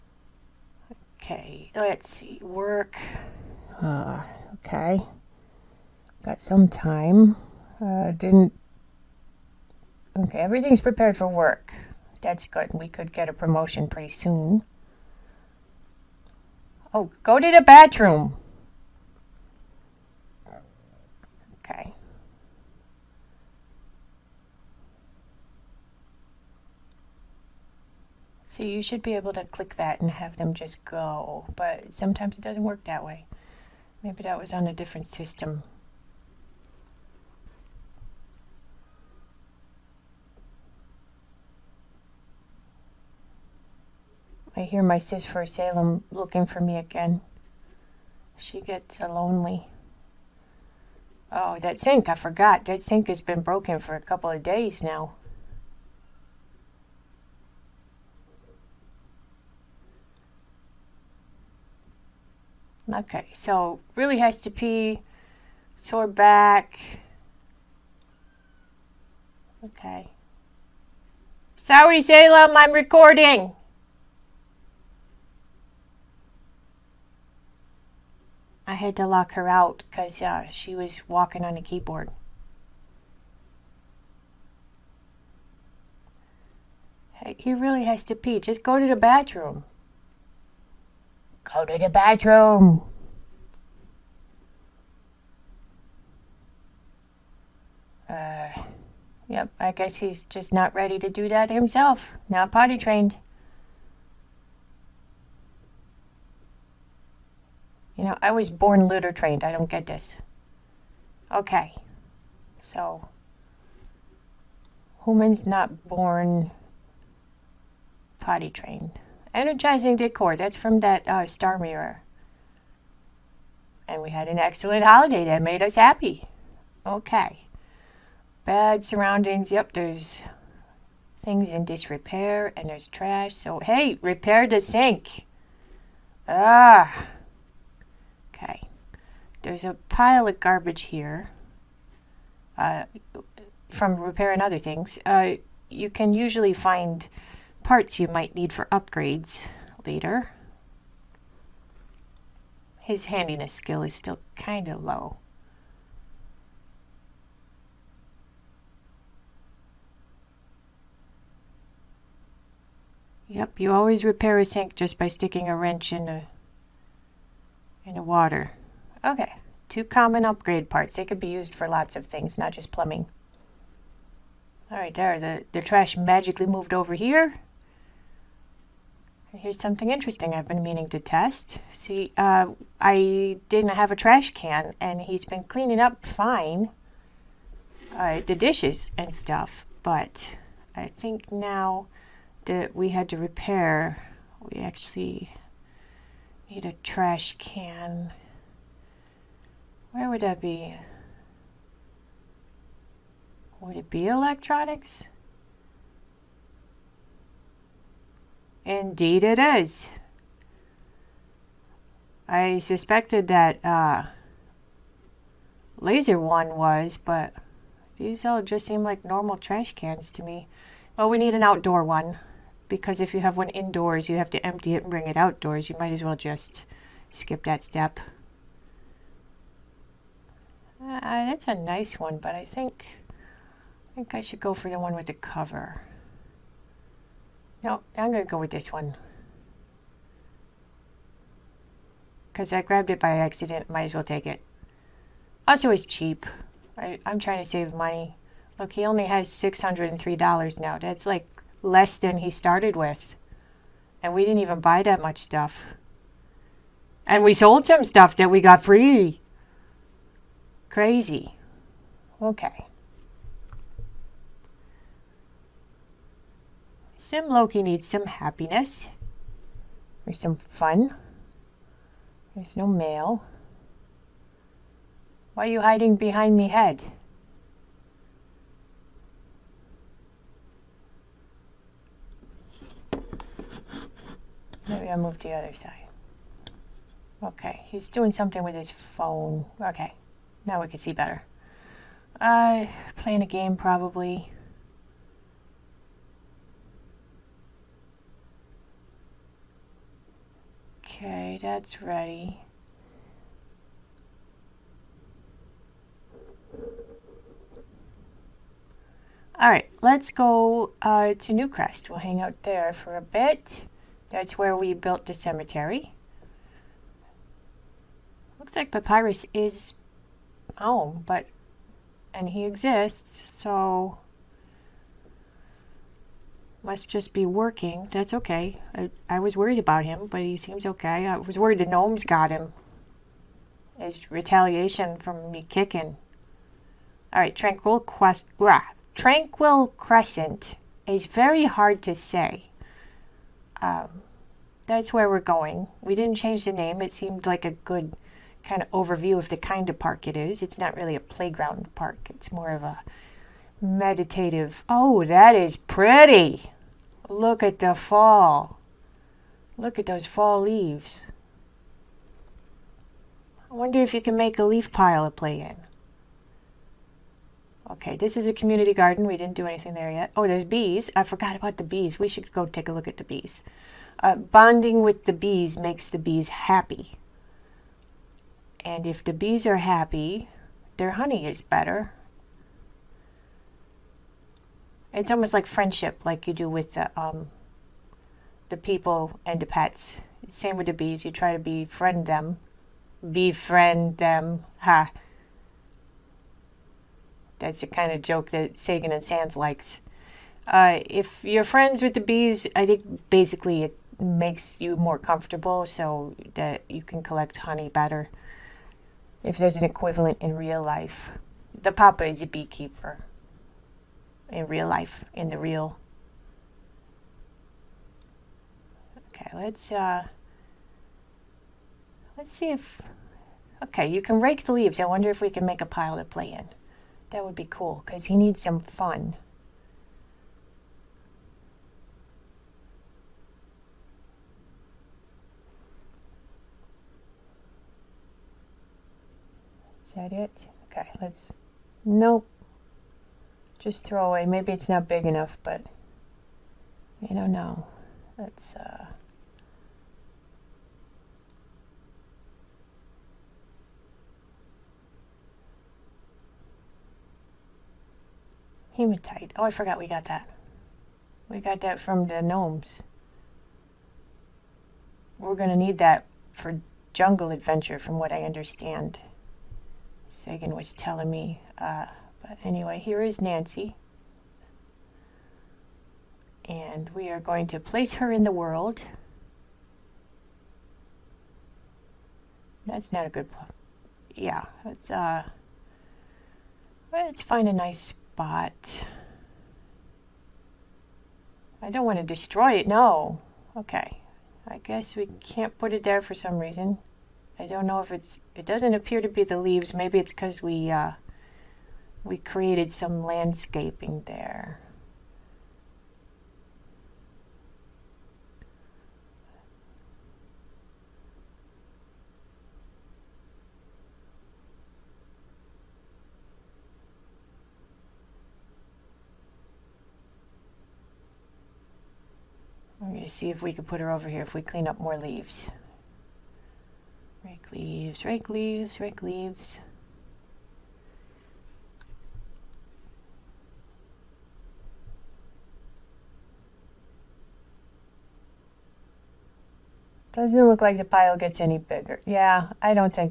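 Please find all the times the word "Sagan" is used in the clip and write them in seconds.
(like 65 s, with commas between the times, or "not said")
398 s, 470 s.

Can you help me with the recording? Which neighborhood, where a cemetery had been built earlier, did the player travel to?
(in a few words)
Newcrest.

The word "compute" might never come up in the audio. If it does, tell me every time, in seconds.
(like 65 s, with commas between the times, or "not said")
not said.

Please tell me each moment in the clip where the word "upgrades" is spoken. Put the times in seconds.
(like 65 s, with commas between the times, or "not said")
148 s, 170 s.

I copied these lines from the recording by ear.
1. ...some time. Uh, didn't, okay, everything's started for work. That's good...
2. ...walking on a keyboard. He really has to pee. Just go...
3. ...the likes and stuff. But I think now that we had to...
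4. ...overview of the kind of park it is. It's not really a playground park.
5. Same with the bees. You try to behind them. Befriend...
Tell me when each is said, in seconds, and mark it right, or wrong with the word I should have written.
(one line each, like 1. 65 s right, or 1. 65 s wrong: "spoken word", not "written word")
1. 6 s wrong: "prepared", not "started"
2. 81 s right
3. 188 s wrong: "dishes", not "likes"
4. 348 s right
5. 390 s wrong: "befriend", not "behind".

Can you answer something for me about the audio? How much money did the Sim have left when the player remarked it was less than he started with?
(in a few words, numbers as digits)
$603.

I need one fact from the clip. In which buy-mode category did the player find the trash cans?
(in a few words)
electronics.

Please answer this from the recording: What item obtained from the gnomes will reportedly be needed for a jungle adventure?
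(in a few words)
hematite.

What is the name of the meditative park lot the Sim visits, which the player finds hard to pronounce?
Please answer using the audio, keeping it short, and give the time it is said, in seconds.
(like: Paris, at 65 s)
Tranquil Crescent, at 338 s.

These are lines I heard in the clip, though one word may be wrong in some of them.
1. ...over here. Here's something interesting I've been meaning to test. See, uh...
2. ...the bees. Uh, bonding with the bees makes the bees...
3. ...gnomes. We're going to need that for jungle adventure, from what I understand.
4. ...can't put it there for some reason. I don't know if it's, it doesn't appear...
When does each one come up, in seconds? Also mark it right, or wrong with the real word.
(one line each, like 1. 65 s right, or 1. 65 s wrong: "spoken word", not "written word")
1. 176 s right
2. 372 s right
3. 462 s right
4. 495 s right.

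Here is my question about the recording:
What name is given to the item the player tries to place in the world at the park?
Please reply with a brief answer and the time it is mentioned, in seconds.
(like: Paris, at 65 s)
Nancy, at 473 s.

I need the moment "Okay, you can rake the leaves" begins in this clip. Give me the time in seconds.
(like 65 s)
423 s.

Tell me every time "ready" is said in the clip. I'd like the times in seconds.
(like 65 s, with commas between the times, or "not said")
100 s, 301 s.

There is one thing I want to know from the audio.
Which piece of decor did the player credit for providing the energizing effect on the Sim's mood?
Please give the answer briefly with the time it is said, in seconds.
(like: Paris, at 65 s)
star mirror, at 121 s.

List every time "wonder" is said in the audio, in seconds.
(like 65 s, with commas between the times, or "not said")
363 s, 424 s.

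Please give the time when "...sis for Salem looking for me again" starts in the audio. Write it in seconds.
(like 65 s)
44 s.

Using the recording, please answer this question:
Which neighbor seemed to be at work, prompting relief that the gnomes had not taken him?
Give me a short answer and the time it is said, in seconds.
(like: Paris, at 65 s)
Papyrus, at 318 s.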